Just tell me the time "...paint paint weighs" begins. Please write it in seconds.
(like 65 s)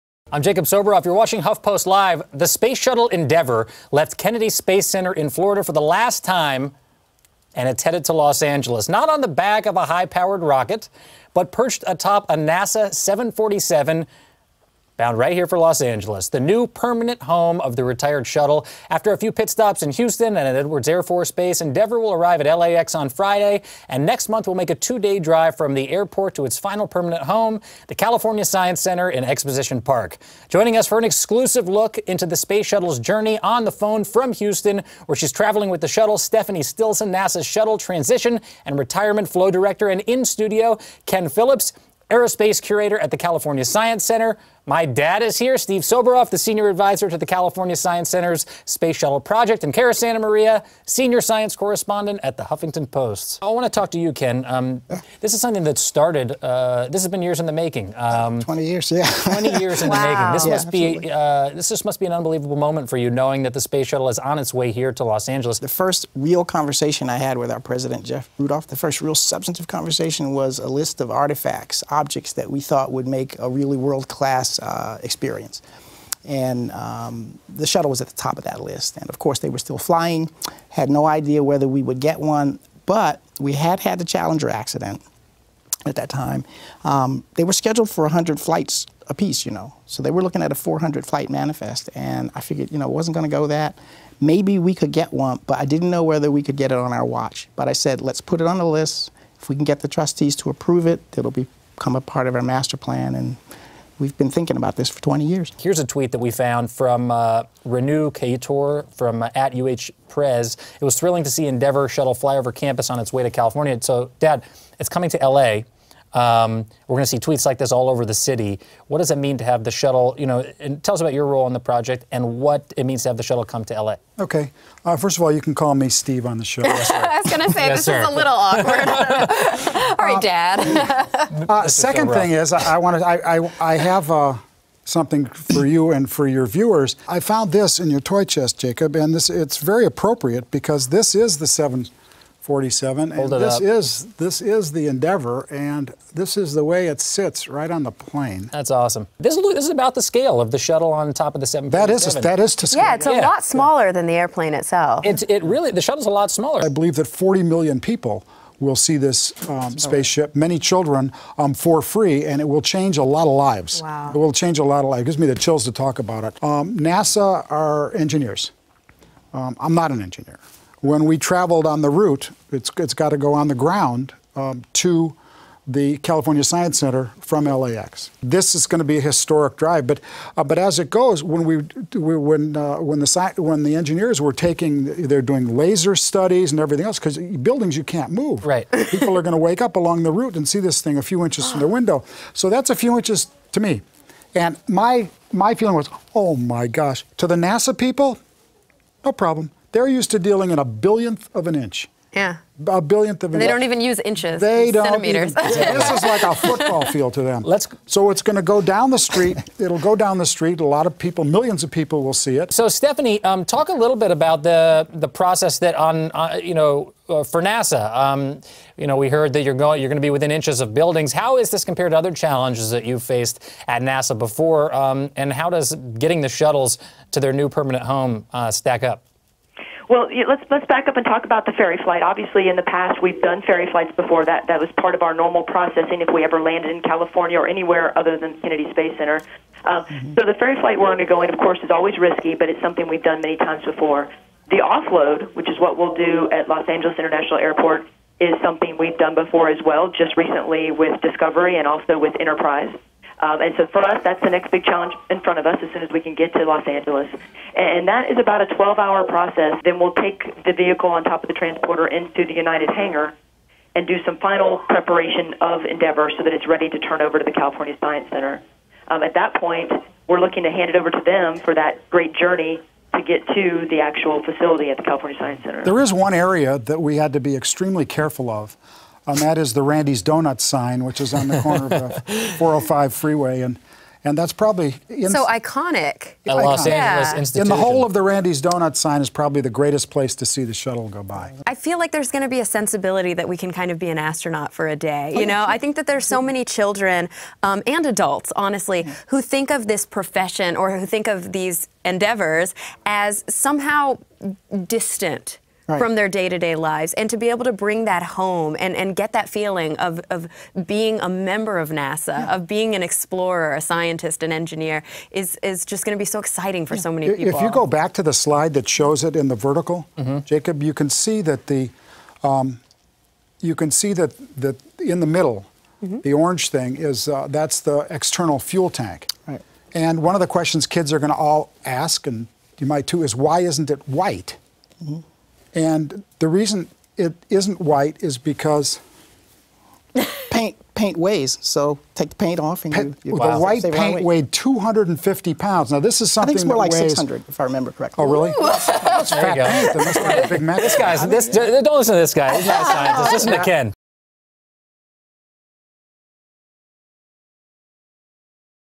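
340 s.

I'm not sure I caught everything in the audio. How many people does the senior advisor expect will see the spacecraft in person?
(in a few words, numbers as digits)
40 million.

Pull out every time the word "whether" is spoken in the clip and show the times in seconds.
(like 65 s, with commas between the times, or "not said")
81 s, 96 s.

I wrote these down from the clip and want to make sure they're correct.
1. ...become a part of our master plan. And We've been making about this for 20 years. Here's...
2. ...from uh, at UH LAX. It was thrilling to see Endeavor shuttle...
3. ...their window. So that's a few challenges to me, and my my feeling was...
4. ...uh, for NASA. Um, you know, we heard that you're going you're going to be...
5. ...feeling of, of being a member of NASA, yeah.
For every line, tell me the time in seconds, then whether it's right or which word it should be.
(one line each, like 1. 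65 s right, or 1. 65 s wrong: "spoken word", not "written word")
1. 101 s wrong: "thinking", not "making"
2. 108 s wrong: "Prez", not "LAX"
3. 191 s wrong: "inches", not "challenges"
4. 217 s right
5. 309 s right.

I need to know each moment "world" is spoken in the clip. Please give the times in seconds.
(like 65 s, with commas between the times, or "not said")
73 s.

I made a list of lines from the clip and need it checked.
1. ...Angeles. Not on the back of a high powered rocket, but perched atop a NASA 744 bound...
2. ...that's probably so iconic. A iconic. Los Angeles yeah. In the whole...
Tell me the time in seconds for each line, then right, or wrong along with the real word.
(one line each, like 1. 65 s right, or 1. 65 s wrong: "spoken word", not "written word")
1. 8 s wrong: "747", not "744"
2. 284 s right.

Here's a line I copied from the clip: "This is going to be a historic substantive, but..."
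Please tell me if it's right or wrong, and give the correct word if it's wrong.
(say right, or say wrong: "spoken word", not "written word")
wrong: "drive", not "substantive".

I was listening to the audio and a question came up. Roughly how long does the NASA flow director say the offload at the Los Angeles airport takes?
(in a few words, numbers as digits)
12 hours.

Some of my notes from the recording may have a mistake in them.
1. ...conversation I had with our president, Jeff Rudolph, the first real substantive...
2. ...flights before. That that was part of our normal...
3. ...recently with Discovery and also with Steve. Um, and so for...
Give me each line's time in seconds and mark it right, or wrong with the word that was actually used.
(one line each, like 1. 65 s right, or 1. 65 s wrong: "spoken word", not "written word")
1. 66 s right
2. 233 s right
3. 250 s wrong: "Enterprise", not "Steve".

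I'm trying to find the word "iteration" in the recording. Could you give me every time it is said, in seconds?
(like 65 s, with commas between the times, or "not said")
not said.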